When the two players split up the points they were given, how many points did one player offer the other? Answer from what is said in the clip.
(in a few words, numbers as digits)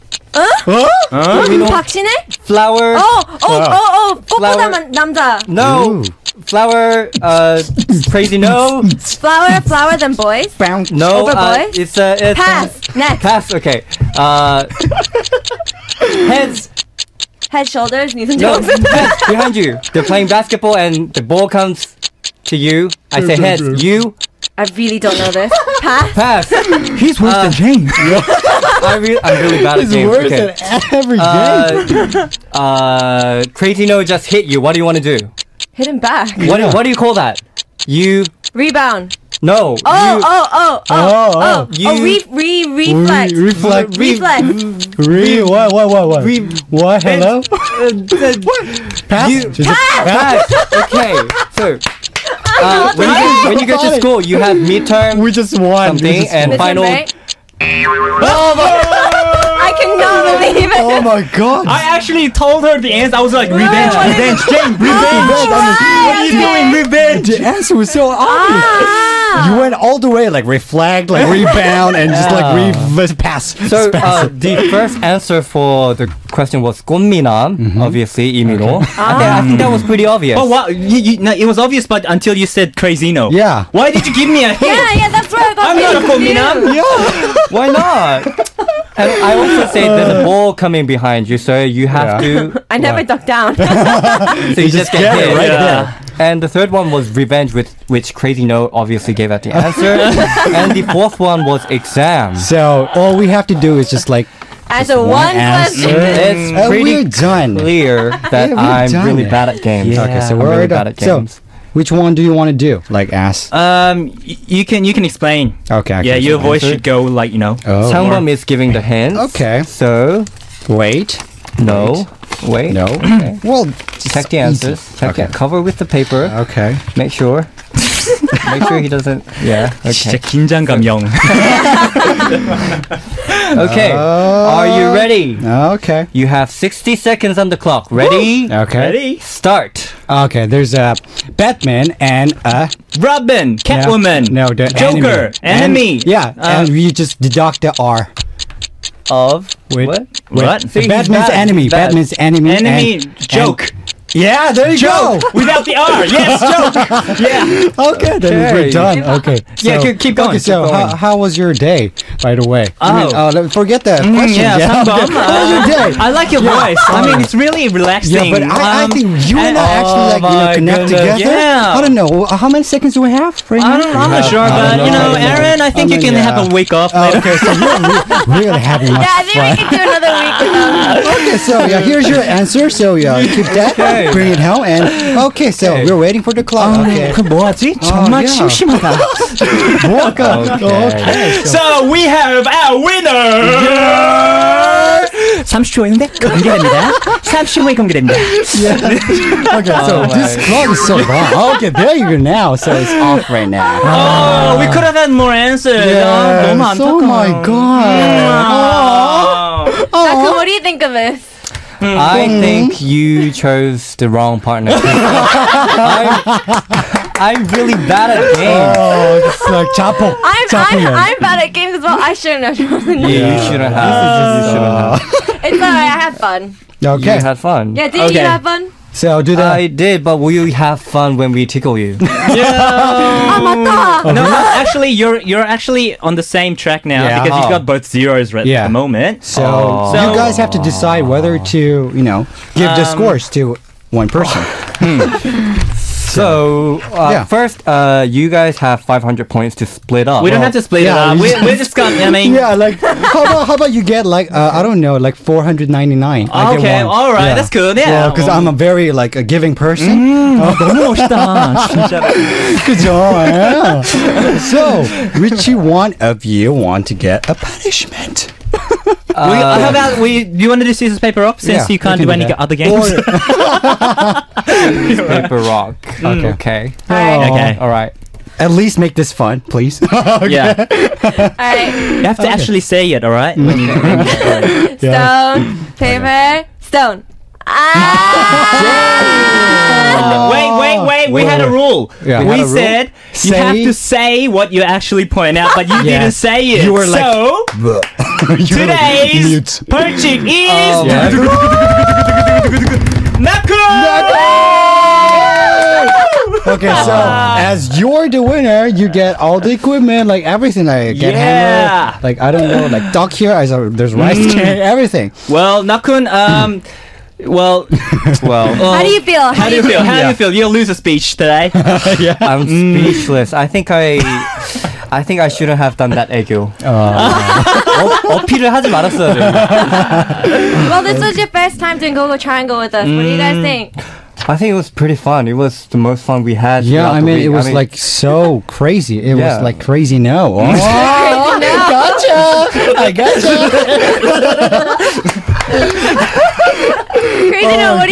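499.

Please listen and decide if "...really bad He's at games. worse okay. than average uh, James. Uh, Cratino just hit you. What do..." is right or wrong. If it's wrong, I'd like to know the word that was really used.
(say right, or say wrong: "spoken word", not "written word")
right.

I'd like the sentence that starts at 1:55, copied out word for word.
I yeah, your voice should go like you know.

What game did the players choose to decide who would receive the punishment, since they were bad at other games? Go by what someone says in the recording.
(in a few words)
scissors, paper, rock.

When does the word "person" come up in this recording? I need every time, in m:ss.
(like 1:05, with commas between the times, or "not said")
4:04, 4:19.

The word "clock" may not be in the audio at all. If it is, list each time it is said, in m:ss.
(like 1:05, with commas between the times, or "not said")
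2:17, 3:06, 3:20.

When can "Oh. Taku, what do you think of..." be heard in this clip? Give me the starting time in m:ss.
3:29.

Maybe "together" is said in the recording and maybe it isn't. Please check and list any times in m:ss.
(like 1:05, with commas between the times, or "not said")
2:51.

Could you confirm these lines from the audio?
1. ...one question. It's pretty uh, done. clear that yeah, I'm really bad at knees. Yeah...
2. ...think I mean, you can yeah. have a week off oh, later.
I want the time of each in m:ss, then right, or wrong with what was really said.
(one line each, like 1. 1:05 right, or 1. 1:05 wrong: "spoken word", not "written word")
1. 1:45 wrong: "games", not "knees"
2. 2:55 right.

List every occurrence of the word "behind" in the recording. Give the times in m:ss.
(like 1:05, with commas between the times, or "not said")
0:19, 1:30.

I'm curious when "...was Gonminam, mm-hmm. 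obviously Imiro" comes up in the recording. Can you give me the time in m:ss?
1:16.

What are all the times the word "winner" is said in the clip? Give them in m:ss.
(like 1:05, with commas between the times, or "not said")
3:12, 5:08.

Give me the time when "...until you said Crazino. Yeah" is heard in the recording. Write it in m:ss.
1:22.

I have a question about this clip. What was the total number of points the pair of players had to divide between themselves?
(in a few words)
500.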